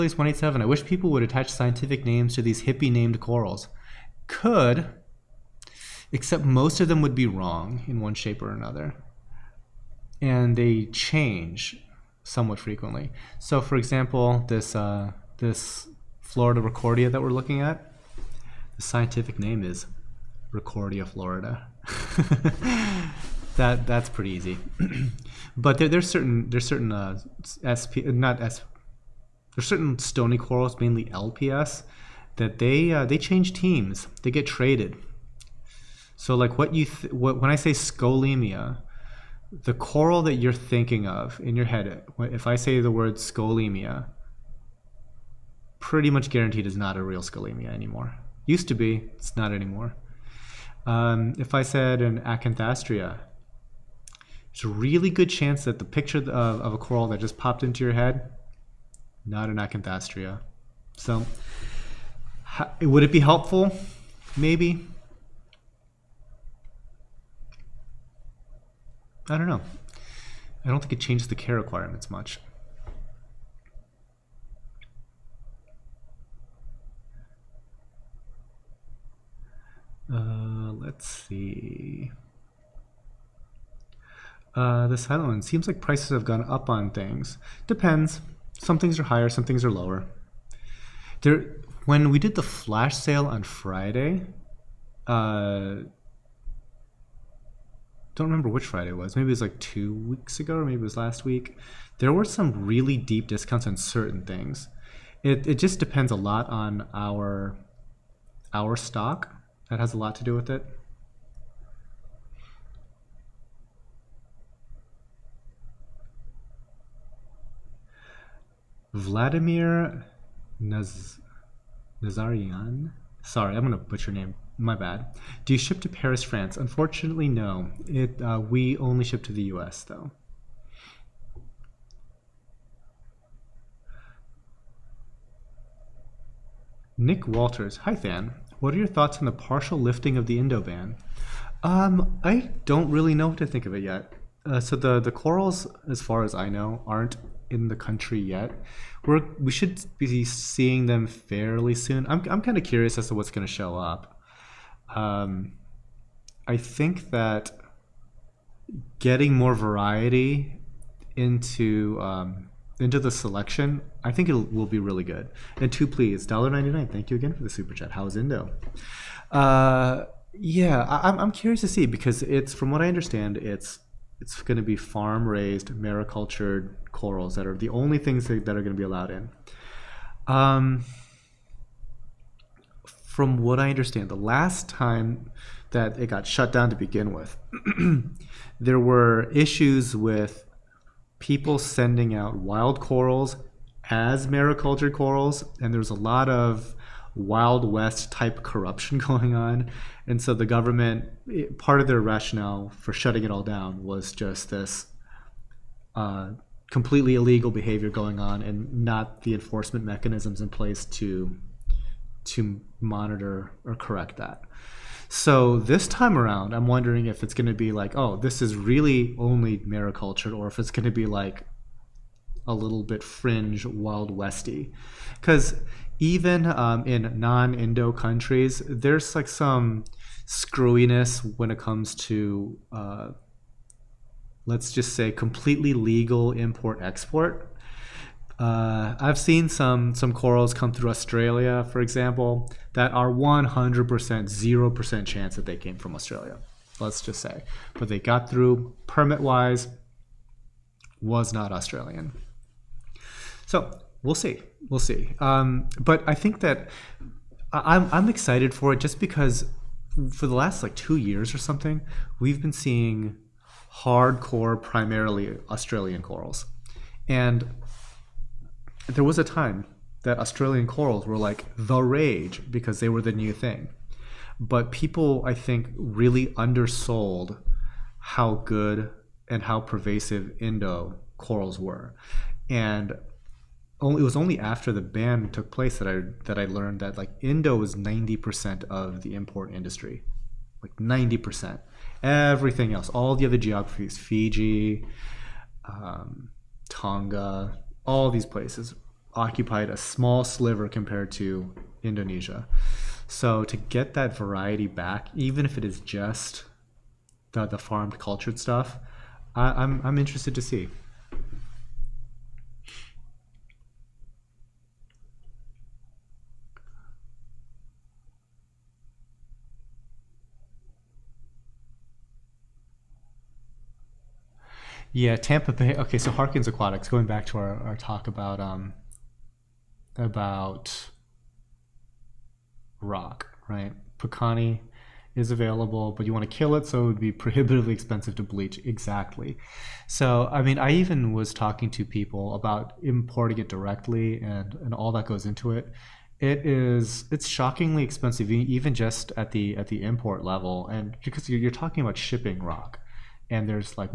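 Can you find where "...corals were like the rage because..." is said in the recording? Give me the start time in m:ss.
4:30.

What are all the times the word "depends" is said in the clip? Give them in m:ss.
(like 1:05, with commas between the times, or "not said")
1:27, 1:45.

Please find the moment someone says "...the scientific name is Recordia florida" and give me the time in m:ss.
0:18.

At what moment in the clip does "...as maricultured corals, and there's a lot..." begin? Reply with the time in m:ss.
3:13.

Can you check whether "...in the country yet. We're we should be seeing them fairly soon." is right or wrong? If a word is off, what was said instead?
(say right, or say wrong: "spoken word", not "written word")
right.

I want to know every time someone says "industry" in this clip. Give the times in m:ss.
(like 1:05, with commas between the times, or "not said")
4:49.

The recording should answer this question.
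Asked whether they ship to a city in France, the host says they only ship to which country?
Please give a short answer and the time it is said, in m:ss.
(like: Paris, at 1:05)
U.S., at 2:09.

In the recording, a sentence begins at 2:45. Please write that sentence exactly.
And two, please, dollar ninety nine.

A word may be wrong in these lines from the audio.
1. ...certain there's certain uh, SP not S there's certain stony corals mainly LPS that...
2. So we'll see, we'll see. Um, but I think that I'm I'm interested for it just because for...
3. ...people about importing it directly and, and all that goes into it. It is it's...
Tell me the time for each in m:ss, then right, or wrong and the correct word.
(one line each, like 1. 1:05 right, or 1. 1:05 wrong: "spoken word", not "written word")
1. 0:26 right
2. 4:13 wrong: "excited", not "interested"
3. 5:41 right.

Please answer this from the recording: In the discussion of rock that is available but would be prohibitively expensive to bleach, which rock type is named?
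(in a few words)
Pukani.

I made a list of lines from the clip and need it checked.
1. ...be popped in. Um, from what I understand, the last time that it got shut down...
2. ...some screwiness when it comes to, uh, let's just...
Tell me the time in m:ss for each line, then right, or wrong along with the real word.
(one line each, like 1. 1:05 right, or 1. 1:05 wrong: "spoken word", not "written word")
1. 2:58 wrong: "allowed", not "popped"
2. 3:49 right.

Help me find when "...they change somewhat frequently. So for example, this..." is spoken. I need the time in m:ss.
0:10.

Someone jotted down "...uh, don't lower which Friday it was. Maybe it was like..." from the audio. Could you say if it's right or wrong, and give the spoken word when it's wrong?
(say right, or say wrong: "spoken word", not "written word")
wrong: "remember", not "lower".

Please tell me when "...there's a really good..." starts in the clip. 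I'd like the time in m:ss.
0:54.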